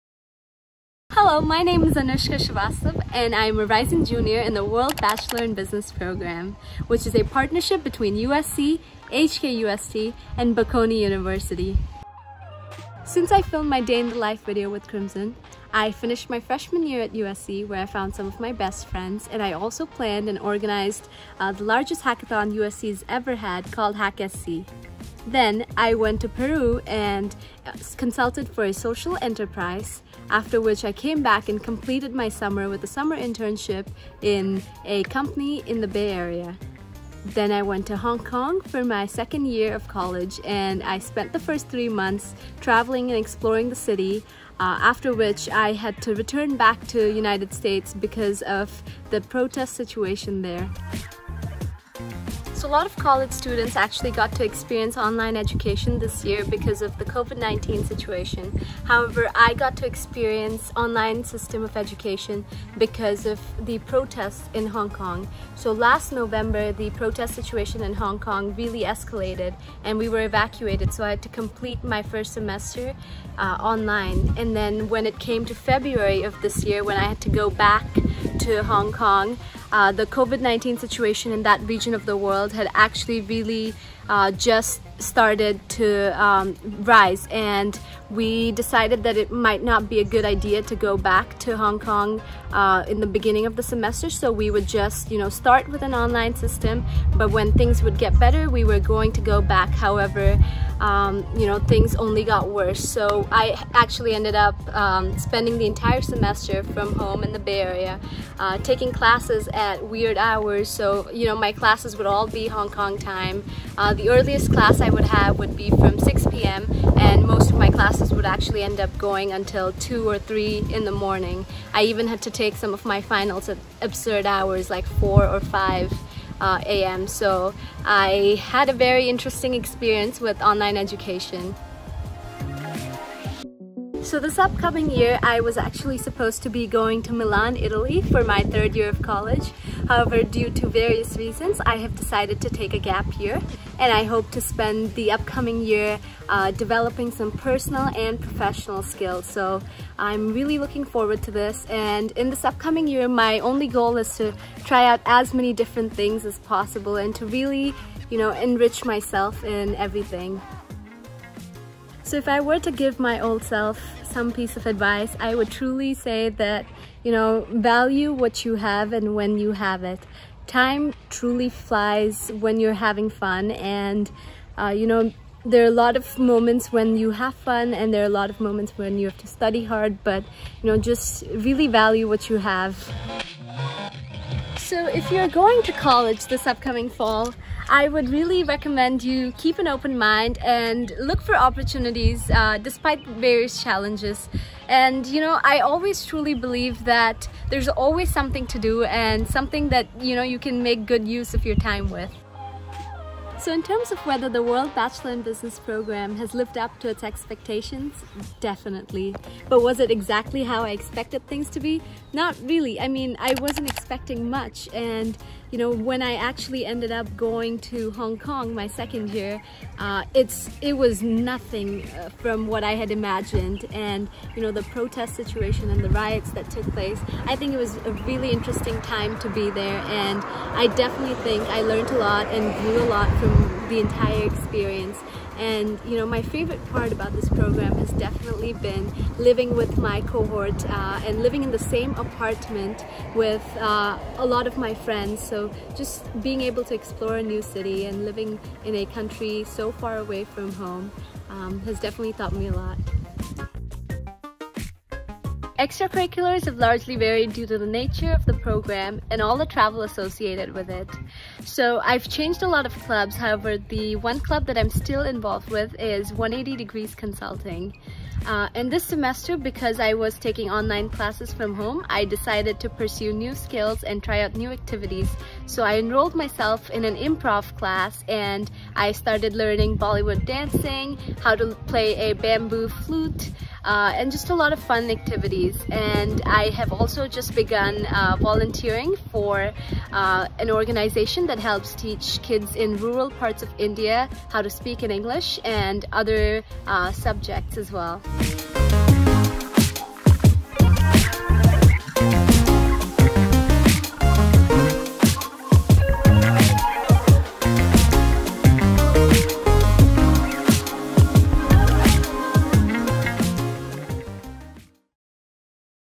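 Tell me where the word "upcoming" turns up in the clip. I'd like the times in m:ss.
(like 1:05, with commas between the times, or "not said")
2:14, 2:25, 2:32, 3:06.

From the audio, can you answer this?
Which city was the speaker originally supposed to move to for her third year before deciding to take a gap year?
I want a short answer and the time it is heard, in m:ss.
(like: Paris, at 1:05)
Milan, at 2:17.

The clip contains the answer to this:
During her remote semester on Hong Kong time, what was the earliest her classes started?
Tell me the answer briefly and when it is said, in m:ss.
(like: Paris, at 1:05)
6 p.m., at 1:55.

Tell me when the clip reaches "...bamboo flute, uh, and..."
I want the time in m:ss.
4:42.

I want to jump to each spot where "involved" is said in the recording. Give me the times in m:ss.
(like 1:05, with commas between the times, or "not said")
4:25.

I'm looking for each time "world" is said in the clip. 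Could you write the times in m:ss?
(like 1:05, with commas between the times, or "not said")
0:04, 1:22, 3:24.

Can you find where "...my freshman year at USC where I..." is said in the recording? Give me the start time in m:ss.
0:16.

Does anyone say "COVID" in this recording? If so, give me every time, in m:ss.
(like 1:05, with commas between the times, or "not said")
0:57, 1:20.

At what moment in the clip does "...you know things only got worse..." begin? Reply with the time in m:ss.
1:41.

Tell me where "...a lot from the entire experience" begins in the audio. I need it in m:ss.
3:52.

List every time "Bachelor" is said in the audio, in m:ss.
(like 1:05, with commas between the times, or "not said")
0:04, 3:24.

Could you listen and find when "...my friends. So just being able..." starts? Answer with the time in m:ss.
4:04.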